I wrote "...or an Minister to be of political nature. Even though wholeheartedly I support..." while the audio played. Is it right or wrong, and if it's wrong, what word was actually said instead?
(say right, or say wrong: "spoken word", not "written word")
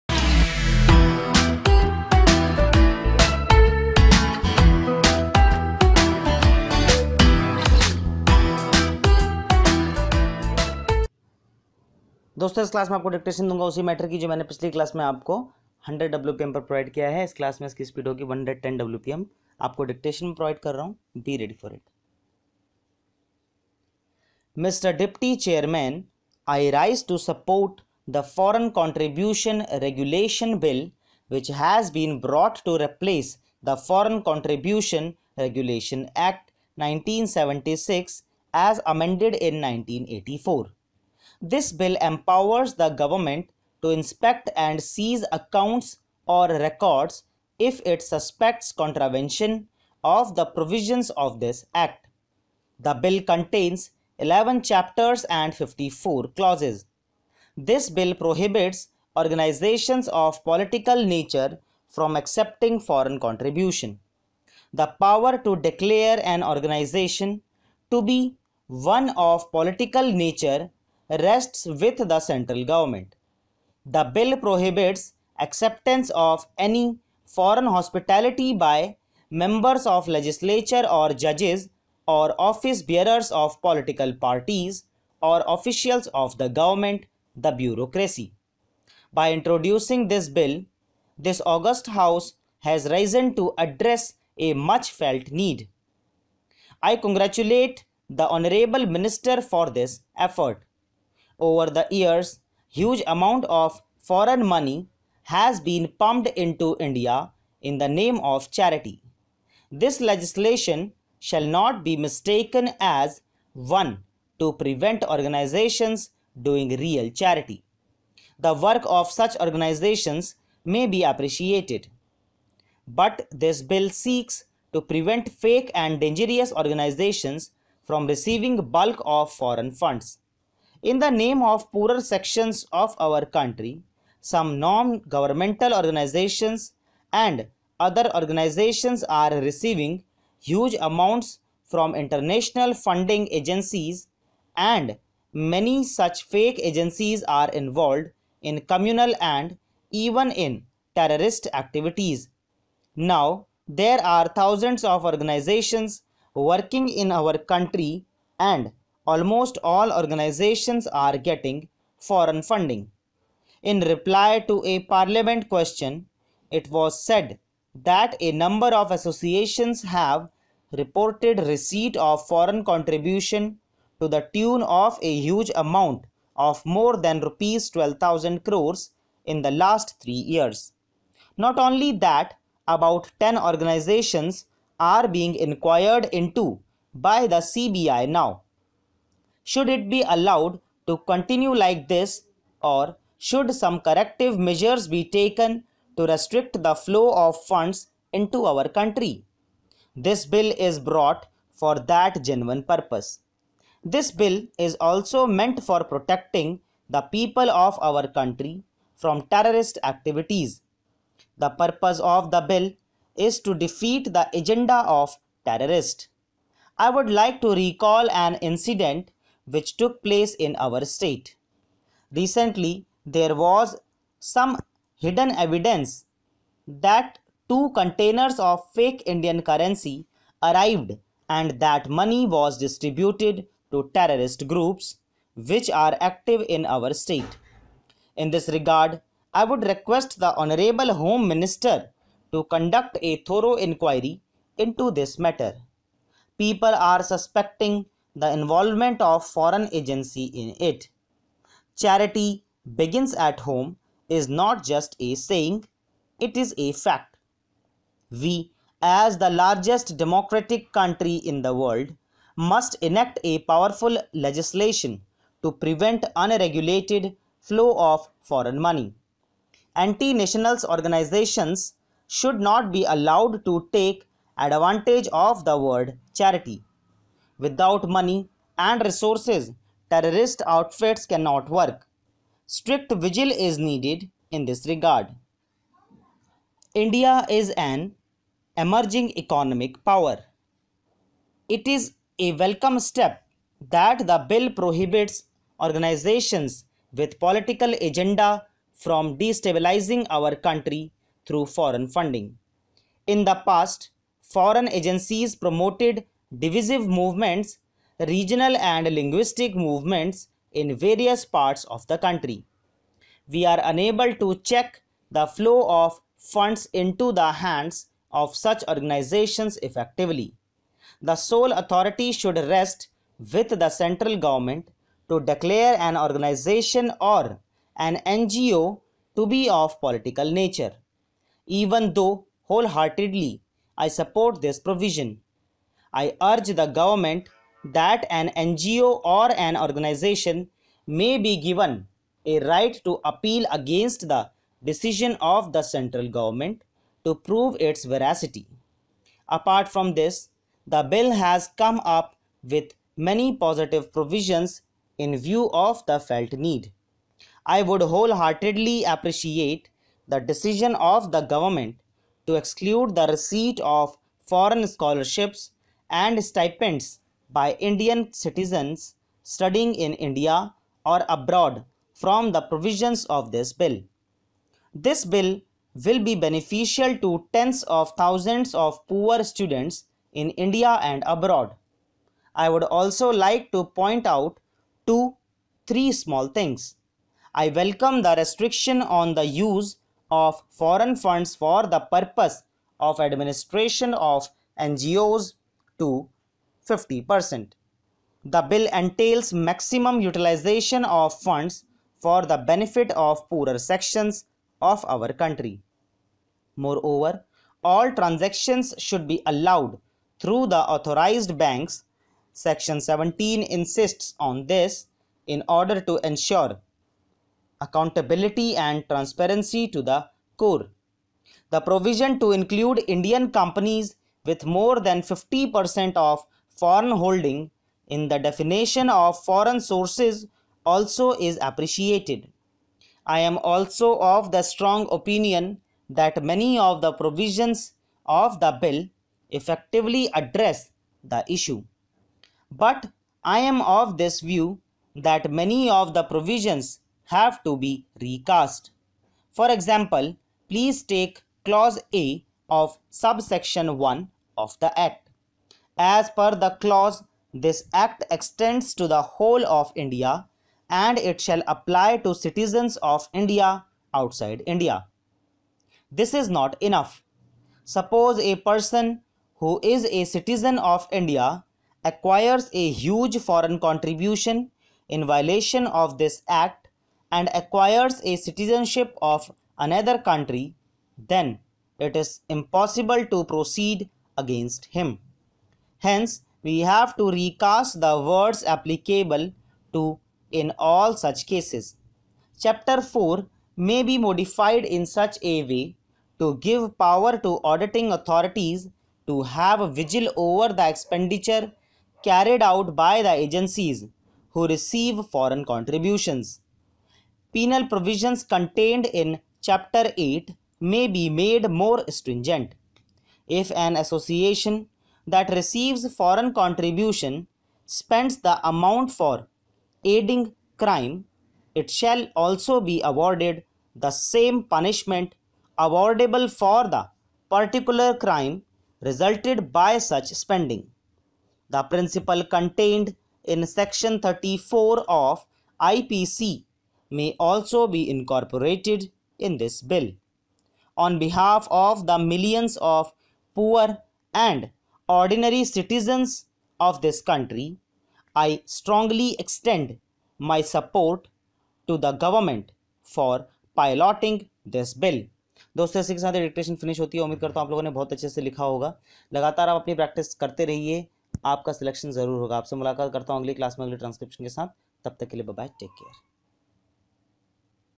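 wrong: "NGO", not "Minister".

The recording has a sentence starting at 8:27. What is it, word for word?
Penal provisions contained in Chapter 8 may be made more stringent.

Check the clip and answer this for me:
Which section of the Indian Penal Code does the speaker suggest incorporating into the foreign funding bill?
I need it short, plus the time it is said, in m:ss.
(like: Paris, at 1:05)
Section 34, at 8:53.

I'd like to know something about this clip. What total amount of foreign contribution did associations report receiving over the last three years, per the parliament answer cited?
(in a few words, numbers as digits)
Rs 12000 crores.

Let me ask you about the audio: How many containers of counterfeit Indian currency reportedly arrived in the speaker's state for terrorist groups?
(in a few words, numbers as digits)
2.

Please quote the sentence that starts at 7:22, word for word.
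But I am of this view that many of the provisions have to be recast.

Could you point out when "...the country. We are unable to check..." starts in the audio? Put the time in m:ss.
5:11.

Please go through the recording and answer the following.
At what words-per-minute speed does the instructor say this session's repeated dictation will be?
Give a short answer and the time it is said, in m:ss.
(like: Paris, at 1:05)
110, at 0:18.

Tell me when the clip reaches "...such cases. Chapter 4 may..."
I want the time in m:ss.
8:10.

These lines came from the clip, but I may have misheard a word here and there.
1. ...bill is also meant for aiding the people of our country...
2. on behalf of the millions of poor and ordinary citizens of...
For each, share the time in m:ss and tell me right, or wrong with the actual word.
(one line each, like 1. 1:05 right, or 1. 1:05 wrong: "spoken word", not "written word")
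1. 3:24 wrong: "protecting", not "aiding"
2. 9:00 right.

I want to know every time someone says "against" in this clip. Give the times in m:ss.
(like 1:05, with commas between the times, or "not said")
5:43, 8:04.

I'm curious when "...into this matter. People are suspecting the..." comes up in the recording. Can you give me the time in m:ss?
4:04.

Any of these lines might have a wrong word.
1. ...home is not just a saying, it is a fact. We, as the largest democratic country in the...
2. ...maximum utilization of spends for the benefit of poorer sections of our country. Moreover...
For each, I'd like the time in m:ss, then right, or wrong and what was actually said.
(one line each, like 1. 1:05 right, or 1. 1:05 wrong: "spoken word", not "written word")
1. 4:13 right
2. 6:39 wrong: "funds", not "spends".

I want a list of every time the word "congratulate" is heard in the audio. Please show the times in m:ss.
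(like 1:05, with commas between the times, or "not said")
1:36.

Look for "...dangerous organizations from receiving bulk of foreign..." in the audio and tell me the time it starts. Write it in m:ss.
2:05.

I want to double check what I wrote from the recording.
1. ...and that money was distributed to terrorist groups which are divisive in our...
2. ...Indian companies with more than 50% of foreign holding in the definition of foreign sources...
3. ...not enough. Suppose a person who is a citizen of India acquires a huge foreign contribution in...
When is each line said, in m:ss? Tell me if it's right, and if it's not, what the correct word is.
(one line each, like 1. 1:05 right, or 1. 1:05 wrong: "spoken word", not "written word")
1. 3:51 wrong: "active", not "divisive"
2. 7:02 right
3. 7:46 right.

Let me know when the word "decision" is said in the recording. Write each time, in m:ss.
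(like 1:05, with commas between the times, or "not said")
5:44, 6:00.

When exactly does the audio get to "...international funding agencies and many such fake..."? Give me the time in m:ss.
2:21.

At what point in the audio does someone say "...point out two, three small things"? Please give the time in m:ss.
6:23.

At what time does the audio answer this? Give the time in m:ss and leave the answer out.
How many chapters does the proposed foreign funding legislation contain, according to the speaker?
0:54.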